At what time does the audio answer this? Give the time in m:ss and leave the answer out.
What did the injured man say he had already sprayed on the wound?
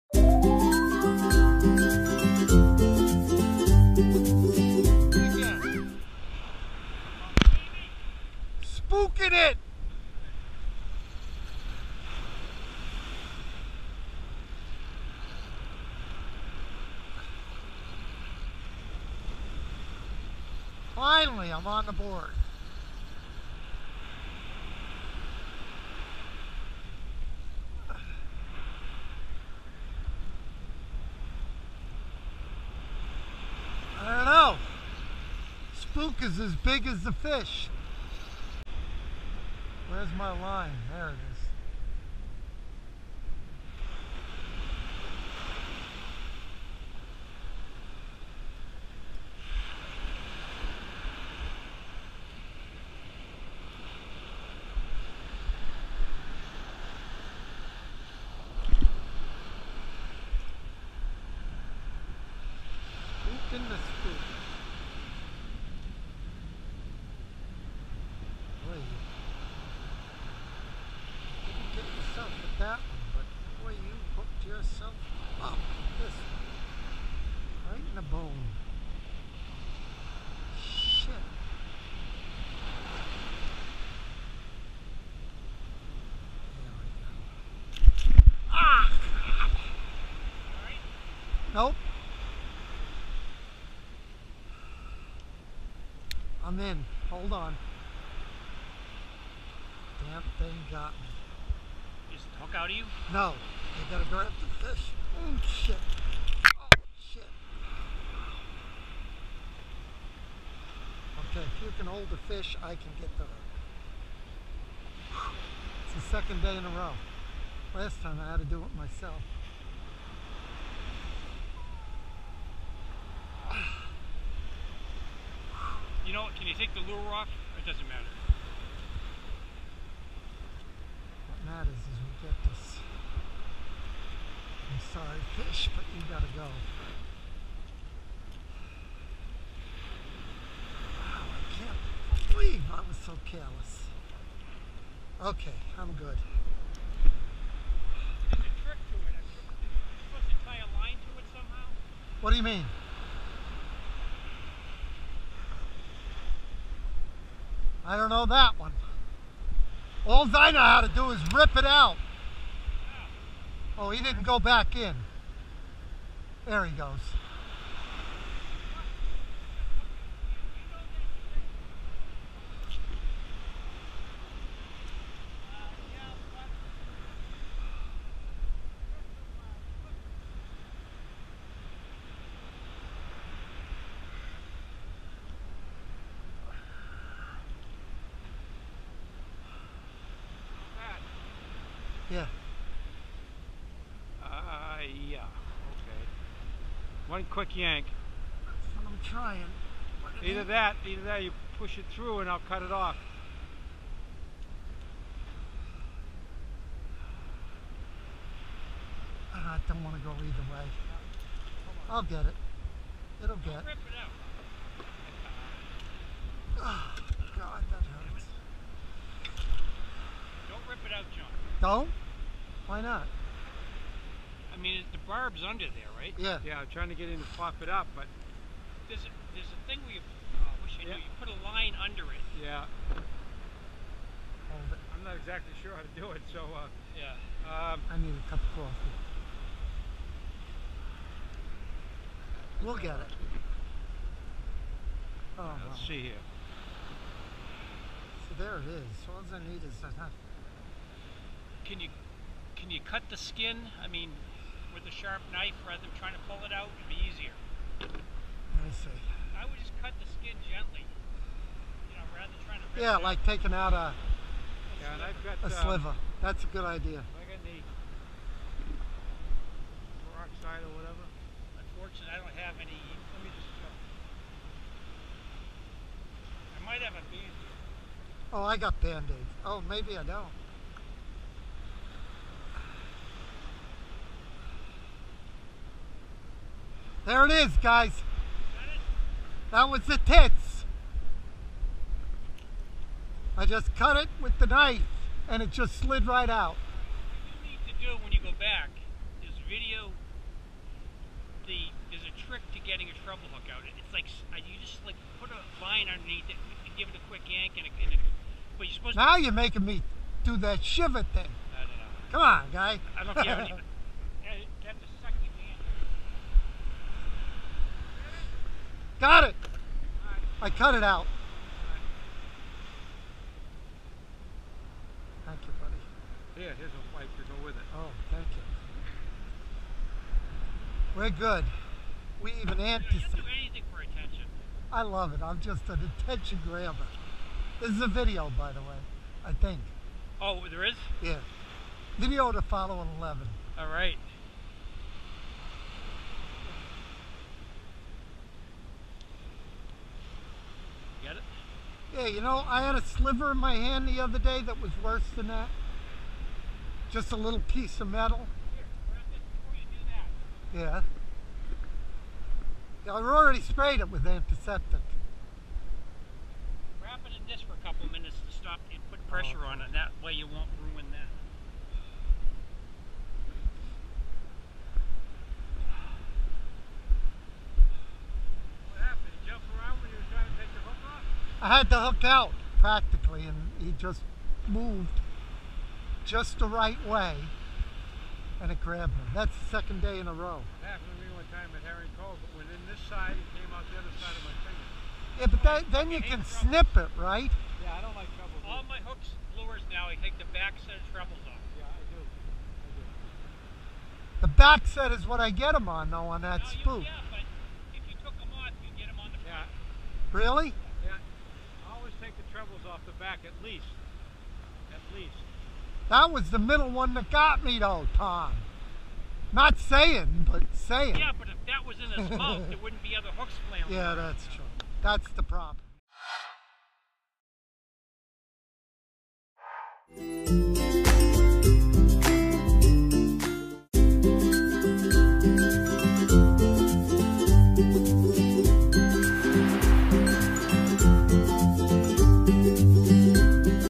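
6:04.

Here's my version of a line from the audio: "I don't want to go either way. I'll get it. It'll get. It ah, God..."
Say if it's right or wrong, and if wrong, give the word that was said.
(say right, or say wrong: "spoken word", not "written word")
right.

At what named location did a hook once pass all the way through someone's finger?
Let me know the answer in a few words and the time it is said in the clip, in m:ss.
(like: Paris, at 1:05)
Harry Cove, at 6:31.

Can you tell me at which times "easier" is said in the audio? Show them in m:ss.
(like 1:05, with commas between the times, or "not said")
4:17.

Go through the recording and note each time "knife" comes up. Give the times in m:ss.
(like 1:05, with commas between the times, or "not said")
4:15, 4:54.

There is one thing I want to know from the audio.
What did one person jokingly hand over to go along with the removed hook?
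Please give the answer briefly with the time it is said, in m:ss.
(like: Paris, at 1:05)
A pipe, at 5:26.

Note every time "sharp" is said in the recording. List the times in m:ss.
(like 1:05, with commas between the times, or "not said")
4:14.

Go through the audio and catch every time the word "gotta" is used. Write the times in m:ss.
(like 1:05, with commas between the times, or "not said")
1:43, 2:16.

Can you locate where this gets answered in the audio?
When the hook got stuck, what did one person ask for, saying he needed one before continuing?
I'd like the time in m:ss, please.
3:58.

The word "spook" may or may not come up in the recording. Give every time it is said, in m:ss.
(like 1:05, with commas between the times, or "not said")
0:35, 6:46.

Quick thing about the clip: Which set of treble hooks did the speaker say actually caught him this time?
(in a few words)
The middle one.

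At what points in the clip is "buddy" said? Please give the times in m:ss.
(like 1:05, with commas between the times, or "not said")
5:25.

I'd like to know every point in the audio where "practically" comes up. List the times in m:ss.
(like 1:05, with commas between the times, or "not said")
6:22.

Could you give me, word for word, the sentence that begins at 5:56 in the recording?
Just a little piece of metal.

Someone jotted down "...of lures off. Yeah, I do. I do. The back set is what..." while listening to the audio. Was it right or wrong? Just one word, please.
wrong.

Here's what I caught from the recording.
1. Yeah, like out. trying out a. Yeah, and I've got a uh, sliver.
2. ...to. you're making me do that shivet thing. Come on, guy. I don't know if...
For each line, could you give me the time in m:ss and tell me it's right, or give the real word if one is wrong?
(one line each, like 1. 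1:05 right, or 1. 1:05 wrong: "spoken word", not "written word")
1. 4:22 wrong: "taking", not "trying"
2. 5:09 right.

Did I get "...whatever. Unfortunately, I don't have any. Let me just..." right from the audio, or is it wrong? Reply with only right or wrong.
right.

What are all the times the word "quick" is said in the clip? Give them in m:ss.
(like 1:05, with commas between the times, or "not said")
3:17, 5:07.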